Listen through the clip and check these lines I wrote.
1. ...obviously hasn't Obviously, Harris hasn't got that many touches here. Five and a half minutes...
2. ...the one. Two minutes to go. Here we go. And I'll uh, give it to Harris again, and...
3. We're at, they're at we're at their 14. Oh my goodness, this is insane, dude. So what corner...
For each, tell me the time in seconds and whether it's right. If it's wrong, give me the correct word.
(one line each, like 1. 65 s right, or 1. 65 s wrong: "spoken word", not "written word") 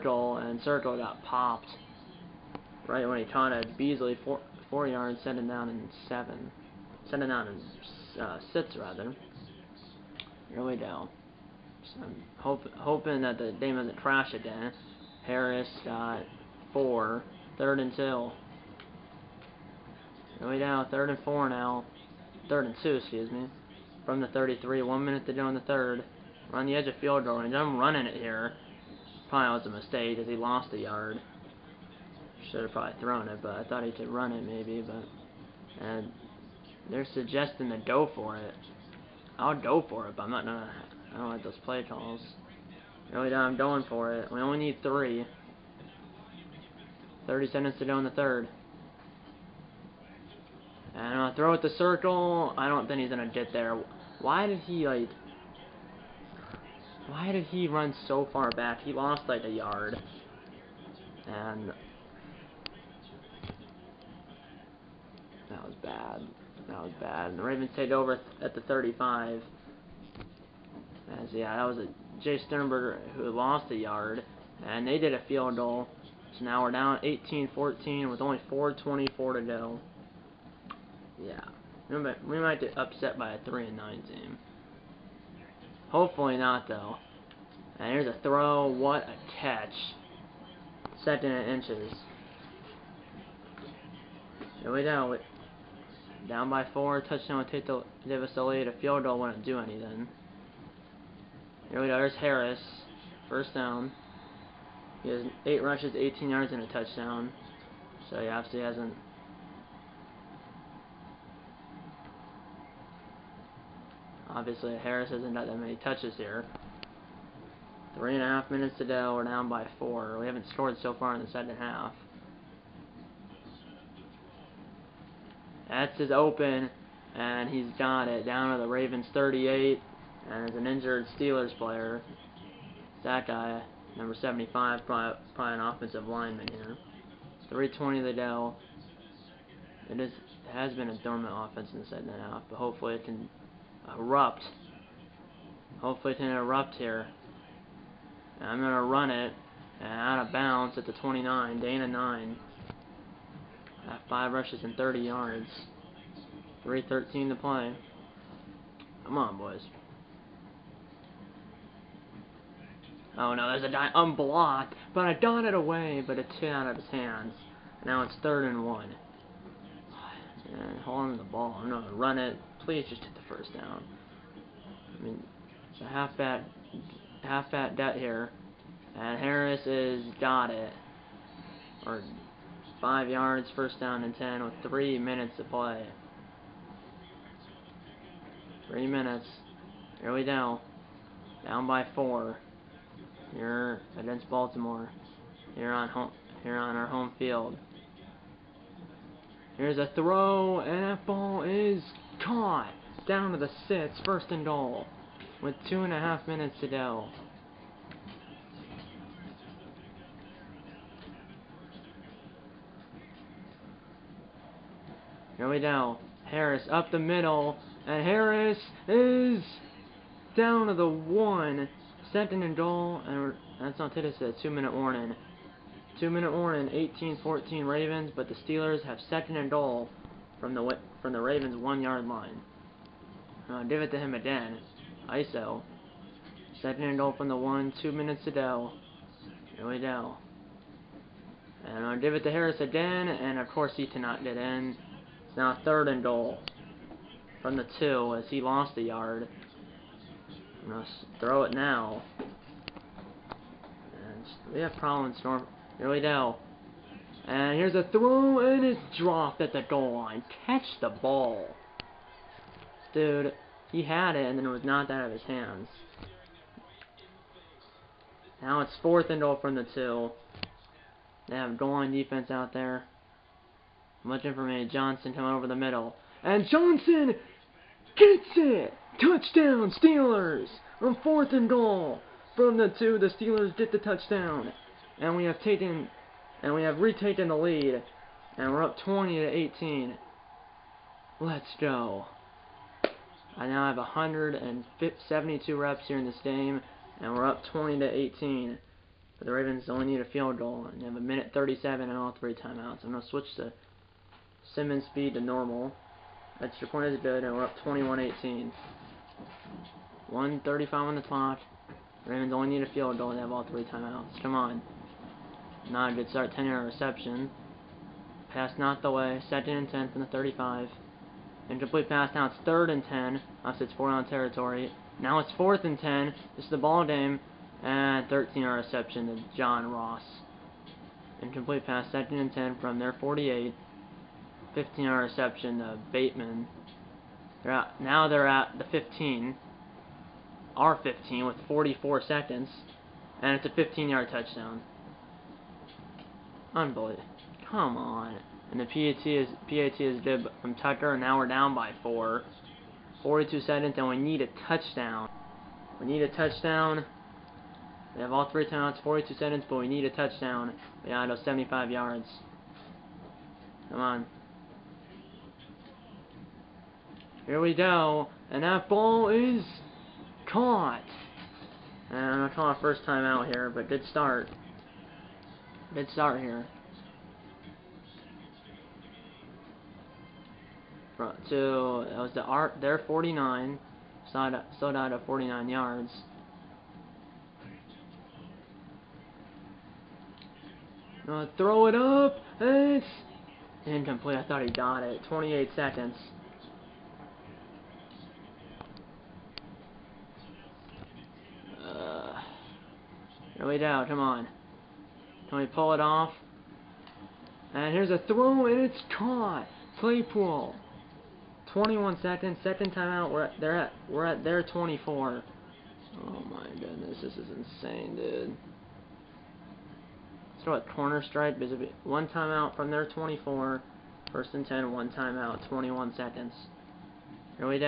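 1. 108 s wrong: "Three", not "Five"
2. 237 s right
3. 413 s wrong: "24", not "14".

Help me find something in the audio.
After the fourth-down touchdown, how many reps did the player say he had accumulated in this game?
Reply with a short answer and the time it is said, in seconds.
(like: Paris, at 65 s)
172, at 293 s.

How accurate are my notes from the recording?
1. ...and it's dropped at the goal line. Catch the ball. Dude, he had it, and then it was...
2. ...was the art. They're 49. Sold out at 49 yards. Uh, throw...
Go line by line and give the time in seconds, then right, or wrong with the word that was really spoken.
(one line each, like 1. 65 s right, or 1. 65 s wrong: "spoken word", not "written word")
1. 258 s right
2. 381 s right.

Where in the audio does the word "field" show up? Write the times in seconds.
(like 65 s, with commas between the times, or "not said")
26 s, 75 s, 98 s, 197 s, 300 s, 312 s.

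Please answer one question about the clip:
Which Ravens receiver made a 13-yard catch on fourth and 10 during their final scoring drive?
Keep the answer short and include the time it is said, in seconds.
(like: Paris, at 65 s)
John Ross, at 329 s.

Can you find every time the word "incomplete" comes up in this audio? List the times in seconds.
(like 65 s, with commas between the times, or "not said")
321 s, 331 s, 393 s.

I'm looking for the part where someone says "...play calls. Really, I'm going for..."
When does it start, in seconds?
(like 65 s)
41 s.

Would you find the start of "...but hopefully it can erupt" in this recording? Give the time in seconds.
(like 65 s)
142 s.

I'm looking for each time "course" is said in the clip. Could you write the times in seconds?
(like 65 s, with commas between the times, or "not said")
243 s.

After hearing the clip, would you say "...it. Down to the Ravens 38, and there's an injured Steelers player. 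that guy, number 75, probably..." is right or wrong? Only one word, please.
right.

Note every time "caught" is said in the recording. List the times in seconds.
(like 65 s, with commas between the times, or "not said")
3 s, 202 s, 370 s, 408 s.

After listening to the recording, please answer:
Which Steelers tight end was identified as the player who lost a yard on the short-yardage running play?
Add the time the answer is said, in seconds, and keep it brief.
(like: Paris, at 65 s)
Jace Sternberger, at 72 s.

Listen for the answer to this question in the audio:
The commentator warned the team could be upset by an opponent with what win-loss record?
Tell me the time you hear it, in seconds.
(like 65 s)
83 s.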